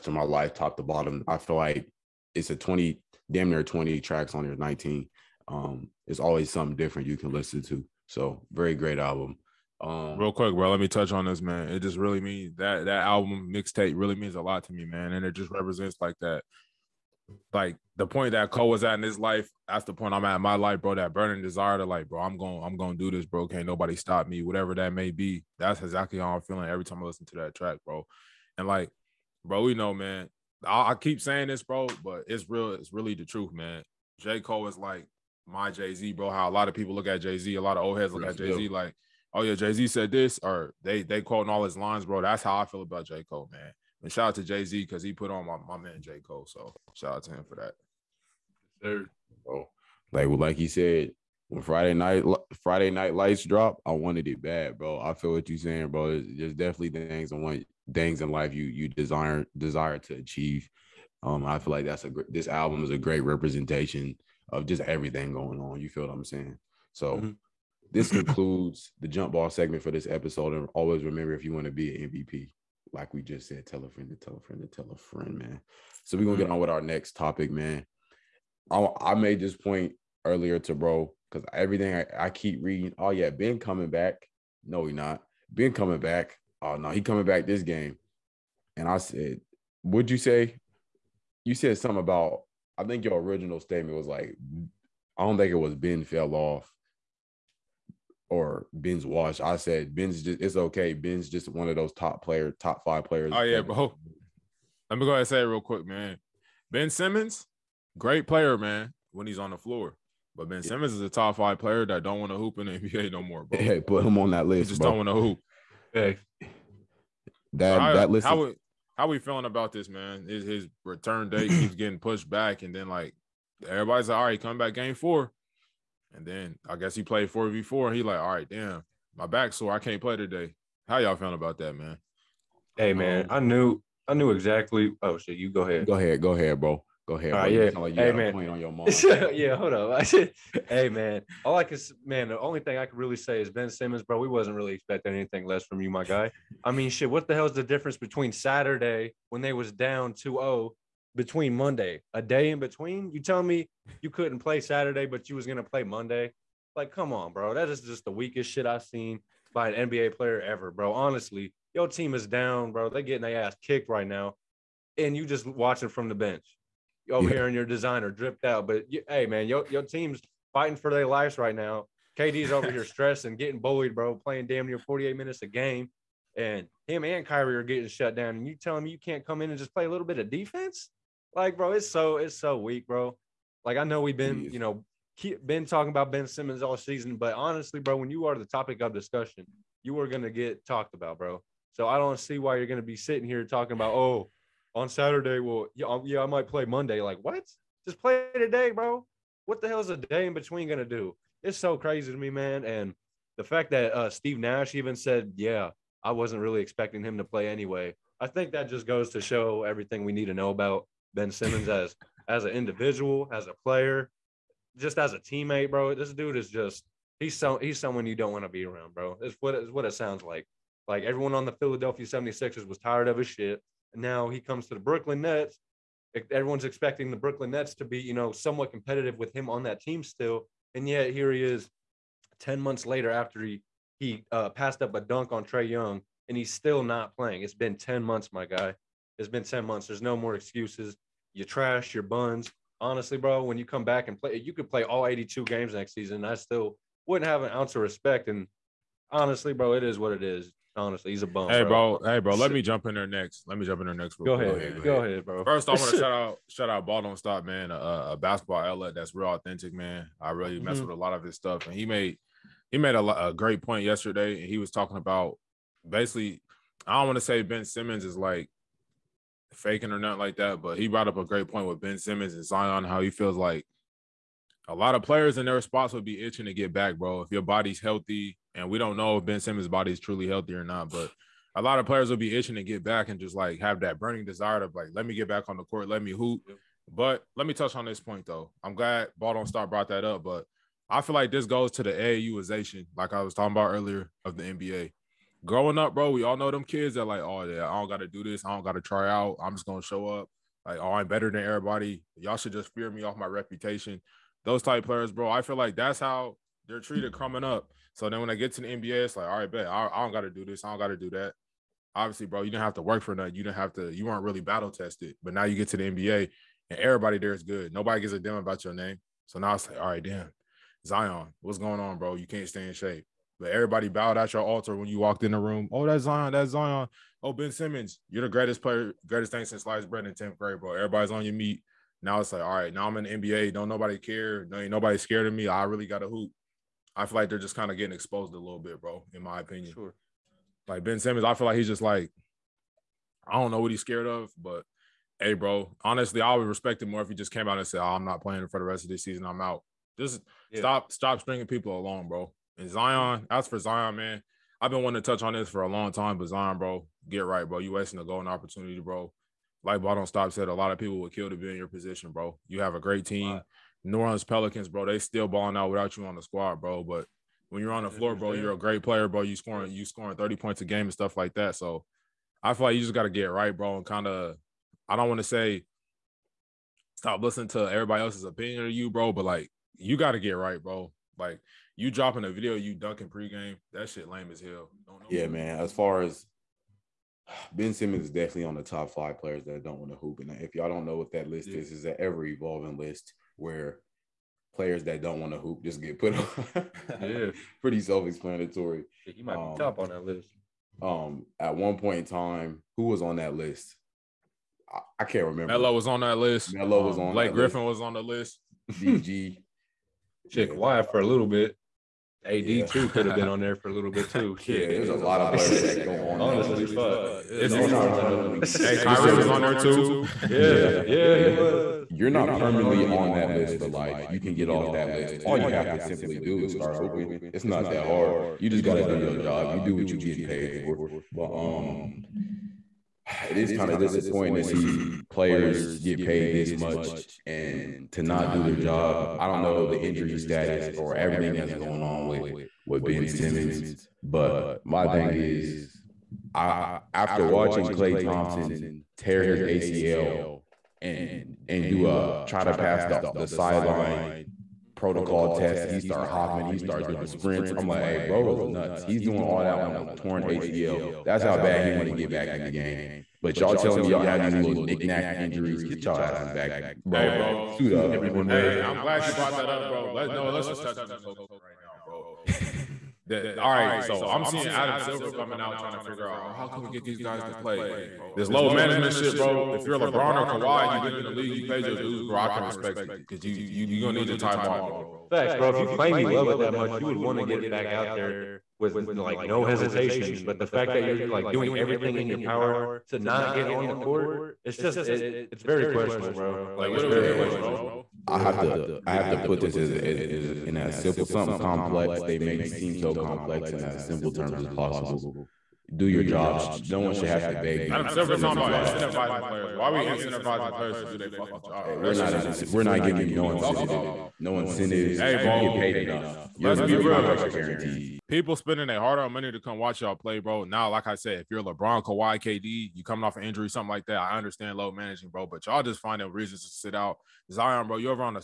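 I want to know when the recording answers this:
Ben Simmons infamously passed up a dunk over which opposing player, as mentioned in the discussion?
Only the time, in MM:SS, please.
03:55.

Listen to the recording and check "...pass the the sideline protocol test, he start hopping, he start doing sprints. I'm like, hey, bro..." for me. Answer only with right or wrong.
right.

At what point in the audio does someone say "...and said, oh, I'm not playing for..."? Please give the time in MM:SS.
05:47.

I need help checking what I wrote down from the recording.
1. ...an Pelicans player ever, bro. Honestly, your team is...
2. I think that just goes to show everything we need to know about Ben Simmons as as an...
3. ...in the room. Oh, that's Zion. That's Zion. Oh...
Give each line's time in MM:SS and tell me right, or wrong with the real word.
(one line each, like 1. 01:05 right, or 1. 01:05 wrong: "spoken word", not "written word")
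1. 02:39 wrong: "NBA", not "Pelicans"
2. 03:28 right
3. 05:25 right.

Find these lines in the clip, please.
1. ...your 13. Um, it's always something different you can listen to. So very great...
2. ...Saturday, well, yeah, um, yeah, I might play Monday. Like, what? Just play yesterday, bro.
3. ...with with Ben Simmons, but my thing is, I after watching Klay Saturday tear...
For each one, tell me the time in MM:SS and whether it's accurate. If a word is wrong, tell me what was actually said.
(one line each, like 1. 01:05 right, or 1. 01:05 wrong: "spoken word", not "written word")
1. 00:04 wrong: "19", not "13"
2. 03:14 wrong: "today", not "yesterday"
3. 07:22 wrong: "Thompson", not "Saturday".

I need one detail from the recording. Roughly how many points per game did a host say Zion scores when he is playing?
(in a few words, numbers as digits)
30.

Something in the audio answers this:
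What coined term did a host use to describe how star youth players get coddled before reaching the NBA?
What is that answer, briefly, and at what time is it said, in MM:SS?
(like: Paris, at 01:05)
AAUization, at 04:51.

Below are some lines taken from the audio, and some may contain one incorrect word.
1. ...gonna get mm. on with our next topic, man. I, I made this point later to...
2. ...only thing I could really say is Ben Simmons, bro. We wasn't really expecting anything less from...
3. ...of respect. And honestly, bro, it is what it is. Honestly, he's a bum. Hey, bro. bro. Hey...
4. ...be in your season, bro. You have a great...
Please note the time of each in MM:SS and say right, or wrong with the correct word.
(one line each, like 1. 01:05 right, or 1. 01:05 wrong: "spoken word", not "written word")
1. 01:16 wrong: "earlier", not "later"
2. 02:22 right
3. 04:07 right
4. 06:01 wrong: "position", not "season".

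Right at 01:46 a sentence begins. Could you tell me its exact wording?
Ben Simmons, great player, man, when he's on the floor.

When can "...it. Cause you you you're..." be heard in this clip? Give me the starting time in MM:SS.
08:02.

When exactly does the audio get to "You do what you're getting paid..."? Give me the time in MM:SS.
07:09.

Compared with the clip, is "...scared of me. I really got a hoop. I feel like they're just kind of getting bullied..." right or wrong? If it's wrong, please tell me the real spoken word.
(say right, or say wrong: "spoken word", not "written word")
wrong: "exposed", not "bullied".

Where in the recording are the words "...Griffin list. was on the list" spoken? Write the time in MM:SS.
06:47.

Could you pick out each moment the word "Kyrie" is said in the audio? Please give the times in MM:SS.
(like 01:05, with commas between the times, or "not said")
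02:57, 06:58.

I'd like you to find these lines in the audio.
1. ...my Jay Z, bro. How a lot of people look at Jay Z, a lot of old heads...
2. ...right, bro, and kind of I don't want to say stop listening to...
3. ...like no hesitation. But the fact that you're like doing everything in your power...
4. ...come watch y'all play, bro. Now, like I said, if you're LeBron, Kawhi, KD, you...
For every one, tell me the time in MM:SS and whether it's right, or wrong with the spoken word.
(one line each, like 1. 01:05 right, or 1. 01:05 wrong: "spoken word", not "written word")
1. 00:35 right
2. 06:13 right
3. 08:08 right
4. 08:39 right.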